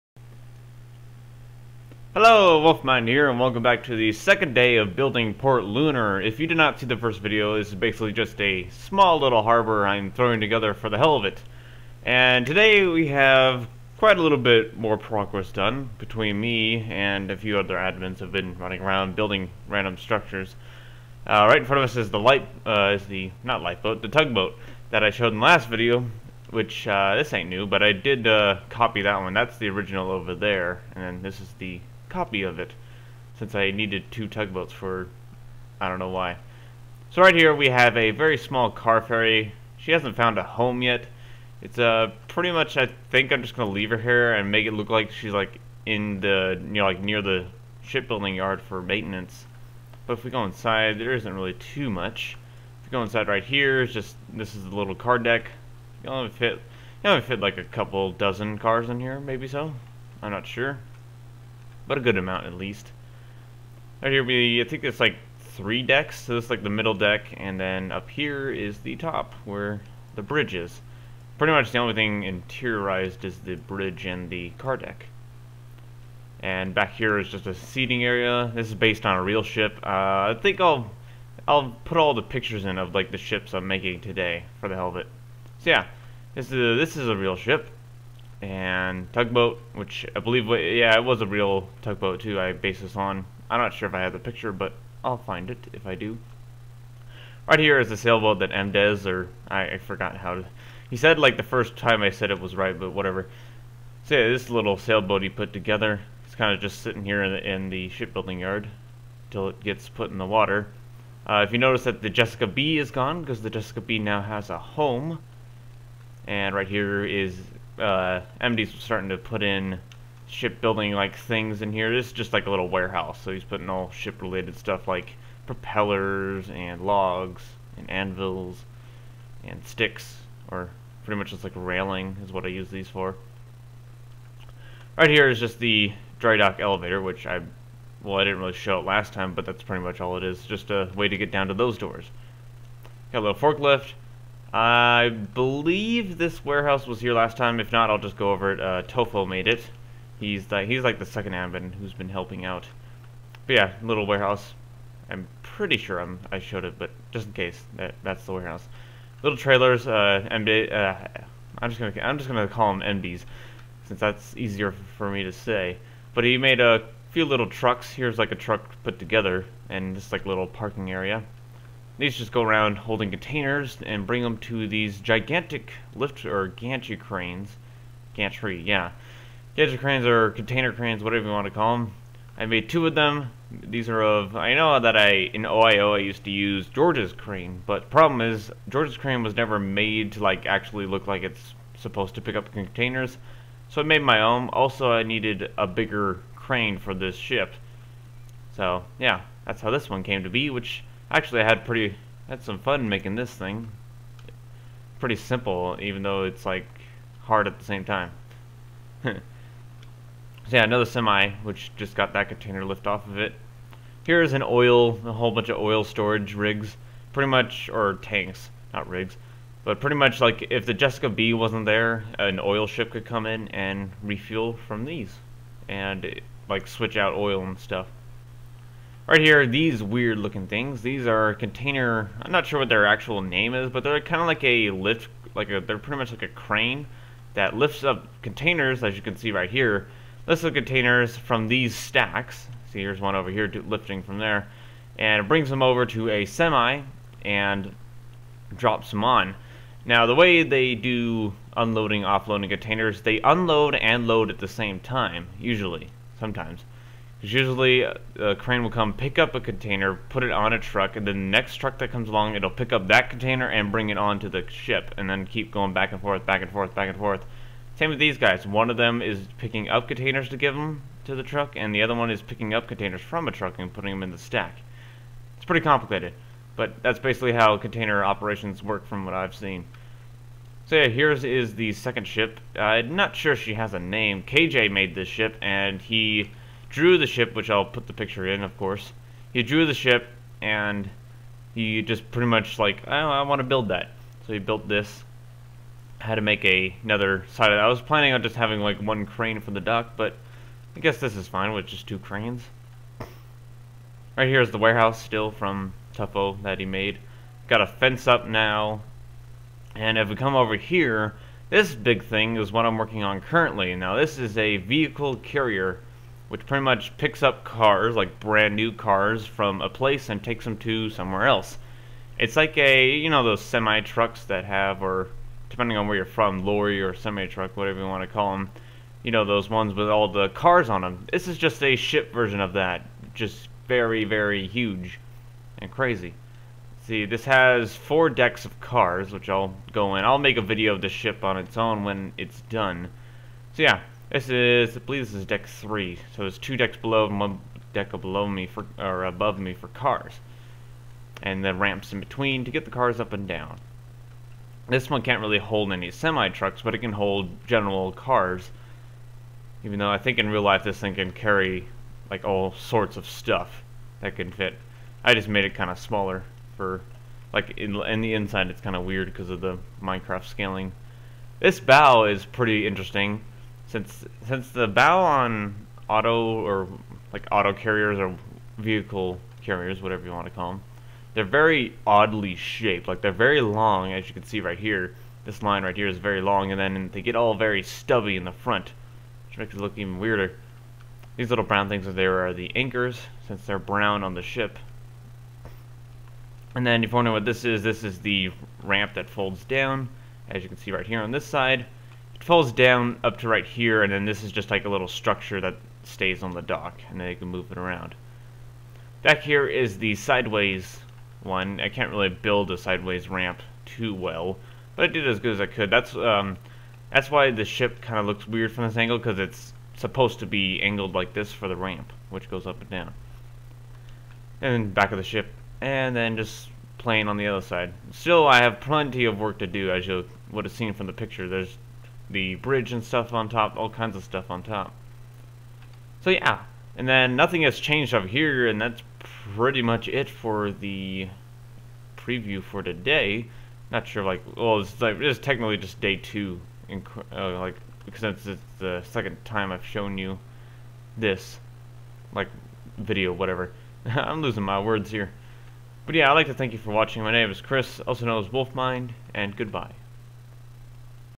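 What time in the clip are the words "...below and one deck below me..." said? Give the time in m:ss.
5:46.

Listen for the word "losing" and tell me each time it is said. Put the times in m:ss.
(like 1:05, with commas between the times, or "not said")
7:34.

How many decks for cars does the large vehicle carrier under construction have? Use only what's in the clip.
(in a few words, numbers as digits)
4.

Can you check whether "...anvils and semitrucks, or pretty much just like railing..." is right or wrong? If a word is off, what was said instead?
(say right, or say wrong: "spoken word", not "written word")
wrong: "sticks", not "semitrucks".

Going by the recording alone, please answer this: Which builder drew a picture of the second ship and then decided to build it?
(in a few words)
KJ.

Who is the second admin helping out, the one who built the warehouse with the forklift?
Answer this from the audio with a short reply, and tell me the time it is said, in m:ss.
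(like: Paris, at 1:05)
Tofo, at 2:28.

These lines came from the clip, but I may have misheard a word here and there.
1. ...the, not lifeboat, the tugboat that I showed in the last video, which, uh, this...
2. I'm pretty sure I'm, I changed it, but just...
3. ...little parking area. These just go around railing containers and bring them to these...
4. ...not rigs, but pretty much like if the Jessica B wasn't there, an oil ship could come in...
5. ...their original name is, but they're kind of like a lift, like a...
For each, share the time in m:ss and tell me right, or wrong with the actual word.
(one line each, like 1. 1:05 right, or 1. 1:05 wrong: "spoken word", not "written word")
1. 0:23 right
2. 2:35 wrong: "showed", not "changed"
3. 2:50 wrong: "holding", not "railing"
4. 3:38 right
5. 3:52 wrong: "actual", not "original".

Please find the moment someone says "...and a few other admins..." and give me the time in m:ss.
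0:16.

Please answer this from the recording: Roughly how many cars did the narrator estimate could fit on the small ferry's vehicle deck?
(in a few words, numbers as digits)
a couple dozen.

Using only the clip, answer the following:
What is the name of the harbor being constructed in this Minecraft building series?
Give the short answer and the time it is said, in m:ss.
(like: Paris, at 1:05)
Port Lunar, at 0:05.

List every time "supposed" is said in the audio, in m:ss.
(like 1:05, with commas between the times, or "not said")
3:11, 6:59.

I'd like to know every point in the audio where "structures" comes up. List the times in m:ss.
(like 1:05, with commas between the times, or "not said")
0:19, 6:44.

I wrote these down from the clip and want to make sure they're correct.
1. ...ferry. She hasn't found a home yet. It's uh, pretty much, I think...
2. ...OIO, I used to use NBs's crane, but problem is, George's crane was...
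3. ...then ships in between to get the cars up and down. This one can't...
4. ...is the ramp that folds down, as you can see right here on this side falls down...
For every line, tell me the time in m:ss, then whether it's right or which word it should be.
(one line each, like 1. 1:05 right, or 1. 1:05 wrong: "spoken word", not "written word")
1. 0:39 right
2. 3:05 wrong: "George", not "NBs"
3. 5:51 wrong: "ramps", not "ships"
4. 6:37 right.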